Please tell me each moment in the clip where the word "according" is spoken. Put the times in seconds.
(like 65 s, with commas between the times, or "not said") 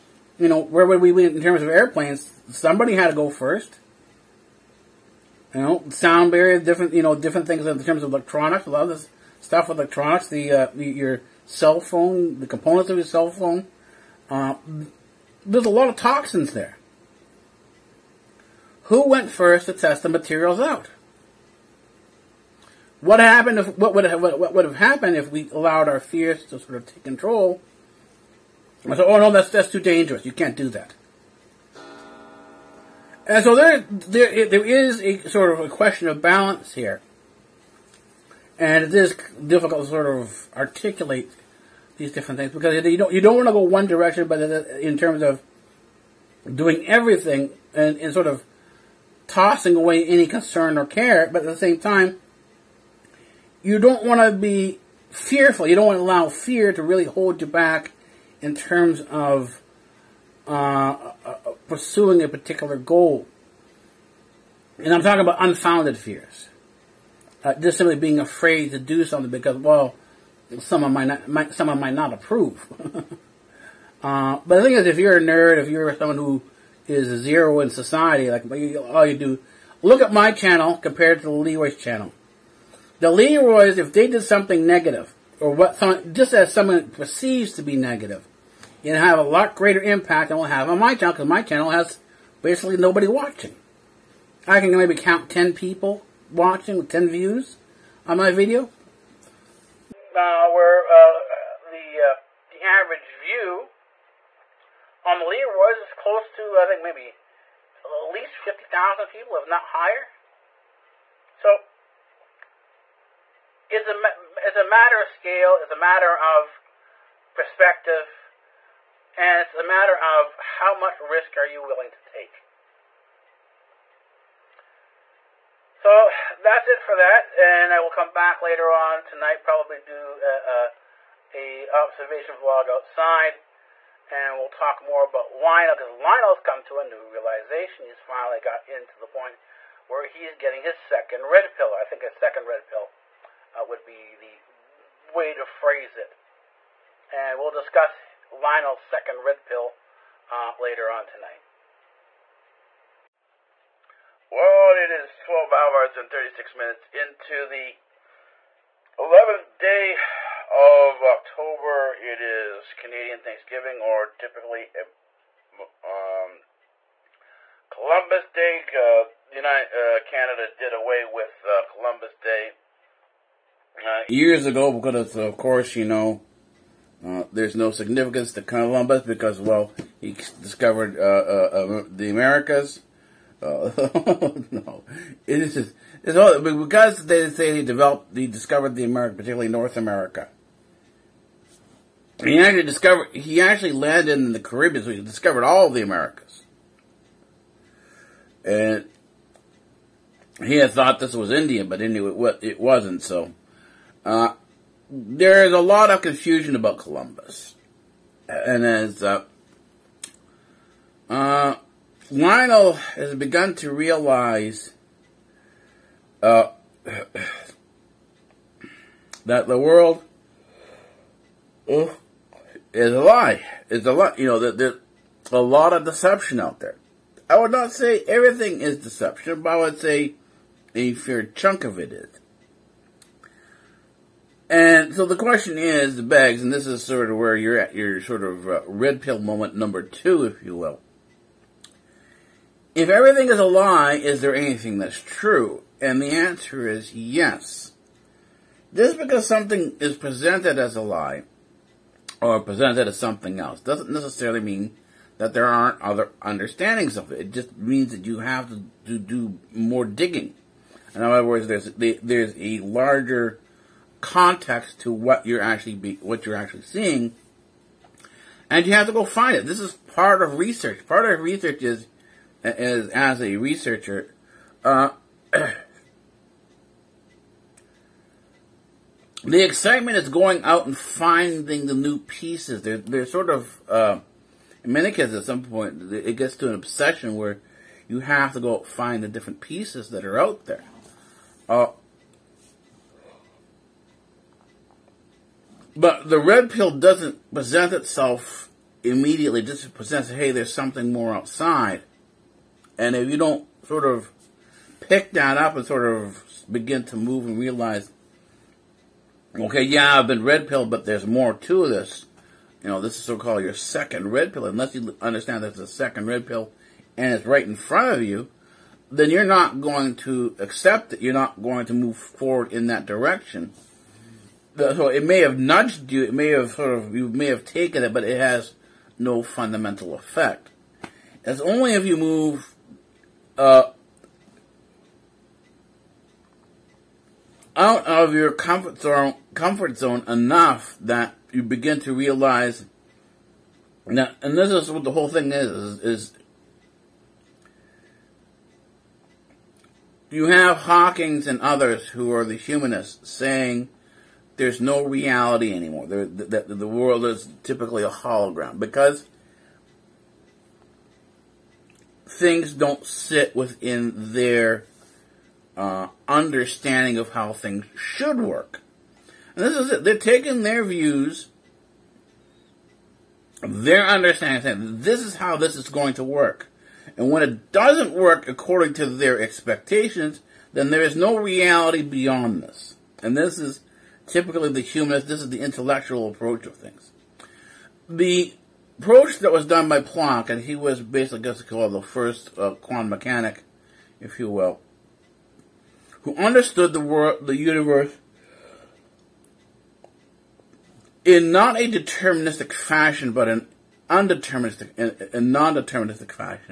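378 s.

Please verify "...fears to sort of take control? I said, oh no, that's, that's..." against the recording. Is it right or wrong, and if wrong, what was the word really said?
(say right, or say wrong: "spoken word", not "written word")
right.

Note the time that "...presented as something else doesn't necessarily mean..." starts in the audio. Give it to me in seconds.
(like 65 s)
252 s.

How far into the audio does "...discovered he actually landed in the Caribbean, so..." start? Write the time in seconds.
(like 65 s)
192 s.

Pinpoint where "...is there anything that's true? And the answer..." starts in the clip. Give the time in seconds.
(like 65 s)
243 s.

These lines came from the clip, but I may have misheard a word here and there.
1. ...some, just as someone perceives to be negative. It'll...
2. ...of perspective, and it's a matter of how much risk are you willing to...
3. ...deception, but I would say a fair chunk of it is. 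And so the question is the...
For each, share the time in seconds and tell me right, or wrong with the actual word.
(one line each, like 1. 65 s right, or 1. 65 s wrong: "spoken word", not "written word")
1. 85 s right
2. 116 s right
3. 228 s right.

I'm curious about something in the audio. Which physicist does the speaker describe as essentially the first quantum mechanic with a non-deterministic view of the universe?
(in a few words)
Planck.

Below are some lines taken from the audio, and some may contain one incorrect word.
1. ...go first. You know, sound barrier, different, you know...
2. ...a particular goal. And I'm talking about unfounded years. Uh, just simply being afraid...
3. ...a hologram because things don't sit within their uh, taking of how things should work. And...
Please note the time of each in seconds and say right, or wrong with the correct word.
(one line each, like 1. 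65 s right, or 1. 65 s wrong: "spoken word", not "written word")
1. 3 s right
2. 62 s wrong: "fears", not "years"
3. 357 s wrong: "understanding", not "taking".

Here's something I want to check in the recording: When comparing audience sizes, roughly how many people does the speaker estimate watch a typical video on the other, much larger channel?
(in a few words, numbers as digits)
50,000.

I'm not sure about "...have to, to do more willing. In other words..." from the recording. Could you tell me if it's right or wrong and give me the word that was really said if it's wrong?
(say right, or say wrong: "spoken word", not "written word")
wrong: "digging", not "willing".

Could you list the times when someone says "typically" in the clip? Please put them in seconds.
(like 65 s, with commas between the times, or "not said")
164 s, 357 s, 384 s.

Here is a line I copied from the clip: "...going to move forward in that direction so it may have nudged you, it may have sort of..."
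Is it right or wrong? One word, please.
right.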